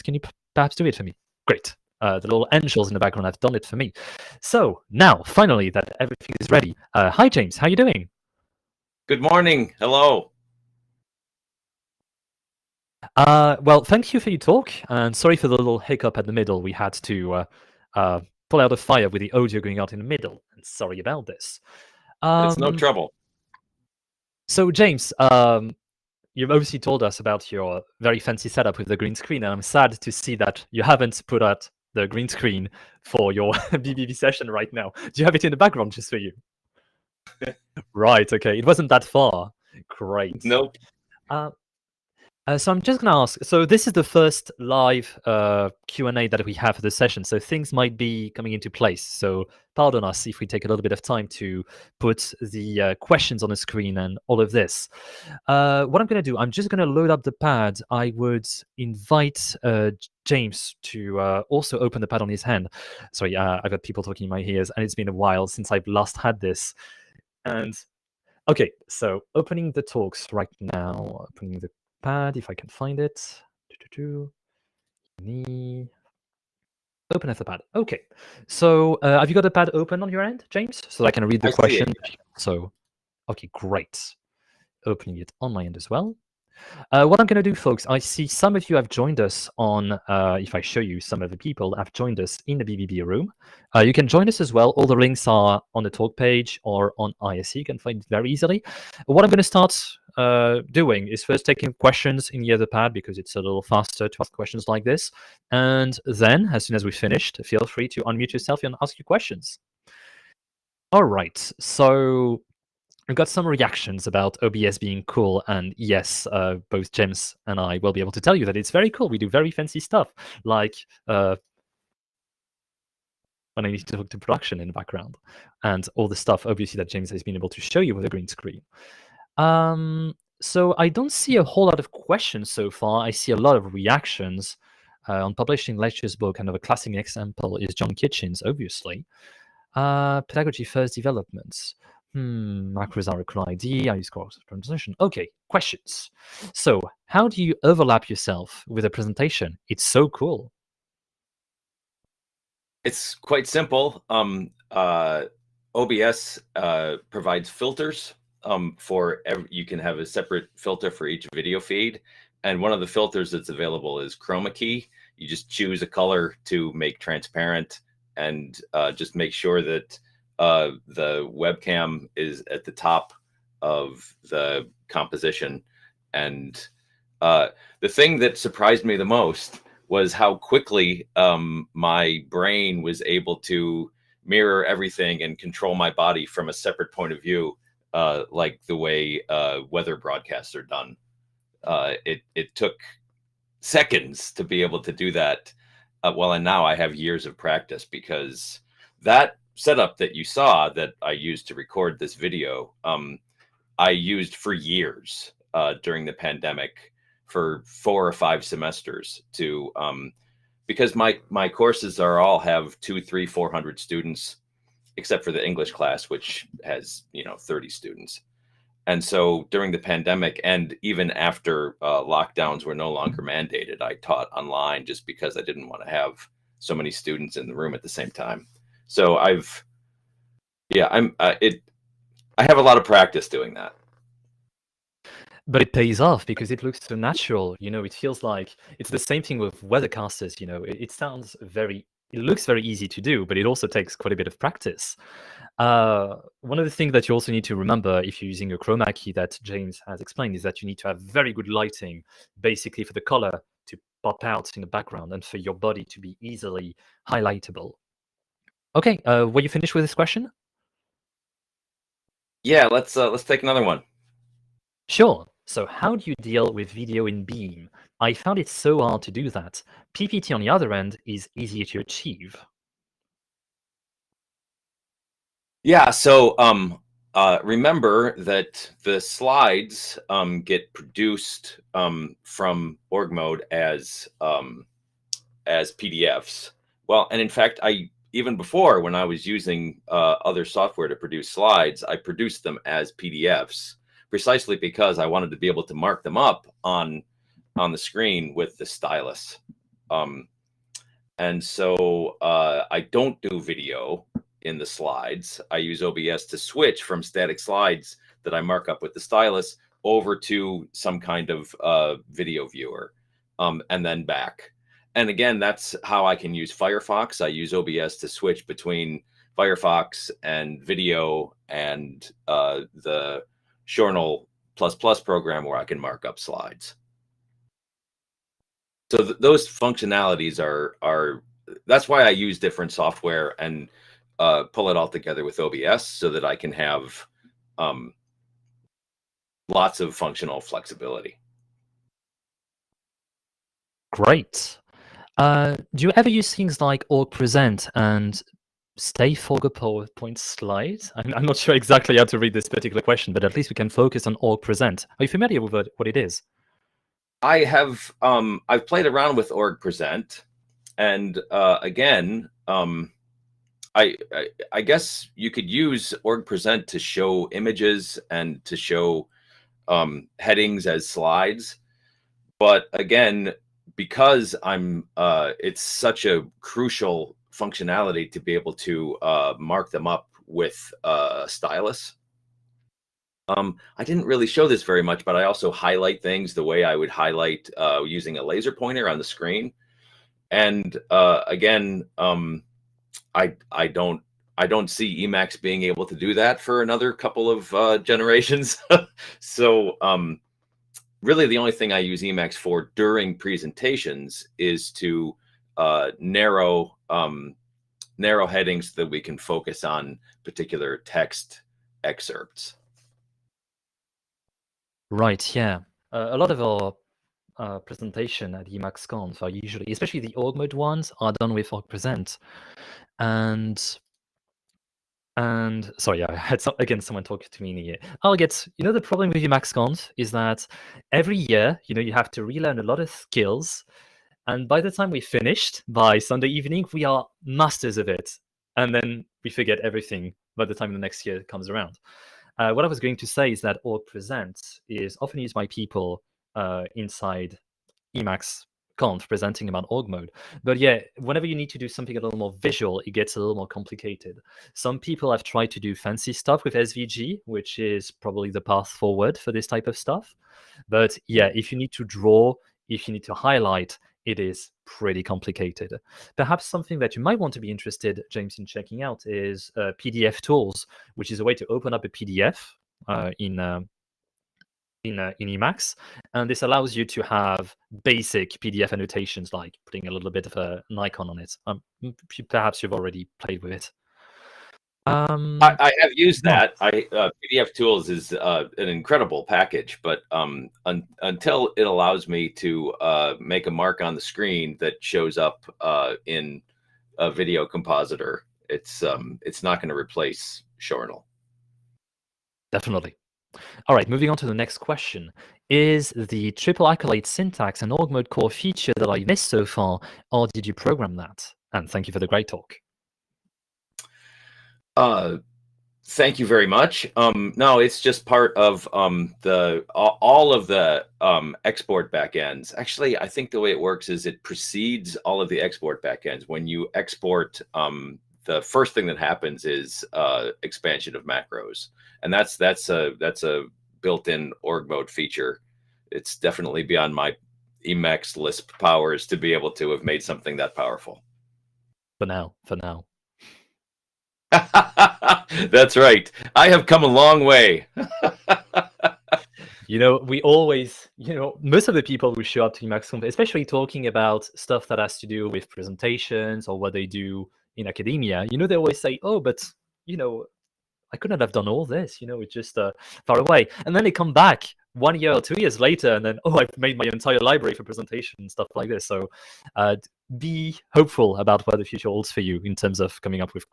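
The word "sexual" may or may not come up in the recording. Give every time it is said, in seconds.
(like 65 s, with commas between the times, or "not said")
not said.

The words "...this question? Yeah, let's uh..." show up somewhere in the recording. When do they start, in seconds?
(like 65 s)
259 s.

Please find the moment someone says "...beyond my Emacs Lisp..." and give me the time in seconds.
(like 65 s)
536 s.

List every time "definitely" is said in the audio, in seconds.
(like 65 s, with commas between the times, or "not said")
502 s, 536 s.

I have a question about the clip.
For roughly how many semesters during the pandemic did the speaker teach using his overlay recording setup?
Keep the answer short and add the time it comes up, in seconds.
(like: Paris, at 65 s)
4 or 5, at 207 s.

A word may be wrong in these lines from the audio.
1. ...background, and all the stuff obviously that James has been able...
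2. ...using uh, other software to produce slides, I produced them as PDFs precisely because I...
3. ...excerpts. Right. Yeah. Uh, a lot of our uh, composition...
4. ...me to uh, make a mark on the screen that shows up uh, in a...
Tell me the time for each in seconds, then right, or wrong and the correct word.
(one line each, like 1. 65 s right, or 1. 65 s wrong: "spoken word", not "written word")
1. 124 s right
2. 289 s right
3. 411 s wrong: "presentation", not "composition"
4. 492 s right.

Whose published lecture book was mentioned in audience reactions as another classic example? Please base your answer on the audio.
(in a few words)
John Kitchin.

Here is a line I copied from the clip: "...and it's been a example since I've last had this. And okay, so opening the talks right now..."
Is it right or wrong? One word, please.
wrong.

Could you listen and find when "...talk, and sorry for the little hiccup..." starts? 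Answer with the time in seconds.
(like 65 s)
14 s.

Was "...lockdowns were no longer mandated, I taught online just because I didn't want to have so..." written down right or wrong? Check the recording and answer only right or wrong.
right.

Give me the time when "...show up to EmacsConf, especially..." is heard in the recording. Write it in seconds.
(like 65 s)
552 s.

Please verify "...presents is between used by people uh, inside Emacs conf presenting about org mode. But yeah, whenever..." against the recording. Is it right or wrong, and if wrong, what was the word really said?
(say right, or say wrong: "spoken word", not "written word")
wrong: "often", not "between".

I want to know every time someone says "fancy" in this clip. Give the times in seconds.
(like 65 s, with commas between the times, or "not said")
28 s, 119 s, 455 s.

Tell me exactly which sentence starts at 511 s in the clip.
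And thank you for the great talk.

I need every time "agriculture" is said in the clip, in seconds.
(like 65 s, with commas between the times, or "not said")
not said.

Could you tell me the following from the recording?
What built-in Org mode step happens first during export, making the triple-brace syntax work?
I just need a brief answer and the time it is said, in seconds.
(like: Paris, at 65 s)
Expansion of macros, at 530 s.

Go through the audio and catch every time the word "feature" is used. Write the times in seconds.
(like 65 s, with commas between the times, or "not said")
508 s, 534 s.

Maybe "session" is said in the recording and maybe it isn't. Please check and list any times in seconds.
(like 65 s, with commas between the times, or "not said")
34 s, 46 s.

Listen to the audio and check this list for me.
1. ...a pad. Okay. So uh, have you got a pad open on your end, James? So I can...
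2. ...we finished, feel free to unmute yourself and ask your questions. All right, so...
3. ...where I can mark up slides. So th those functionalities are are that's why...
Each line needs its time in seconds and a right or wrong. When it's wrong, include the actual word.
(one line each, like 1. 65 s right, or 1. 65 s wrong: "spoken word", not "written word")
1. 77 s right
2. 106 s right
3. 325 s right.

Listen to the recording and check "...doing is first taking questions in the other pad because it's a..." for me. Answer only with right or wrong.
right.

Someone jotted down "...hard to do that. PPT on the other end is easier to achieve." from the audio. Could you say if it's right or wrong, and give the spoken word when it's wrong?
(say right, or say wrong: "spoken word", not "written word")
right.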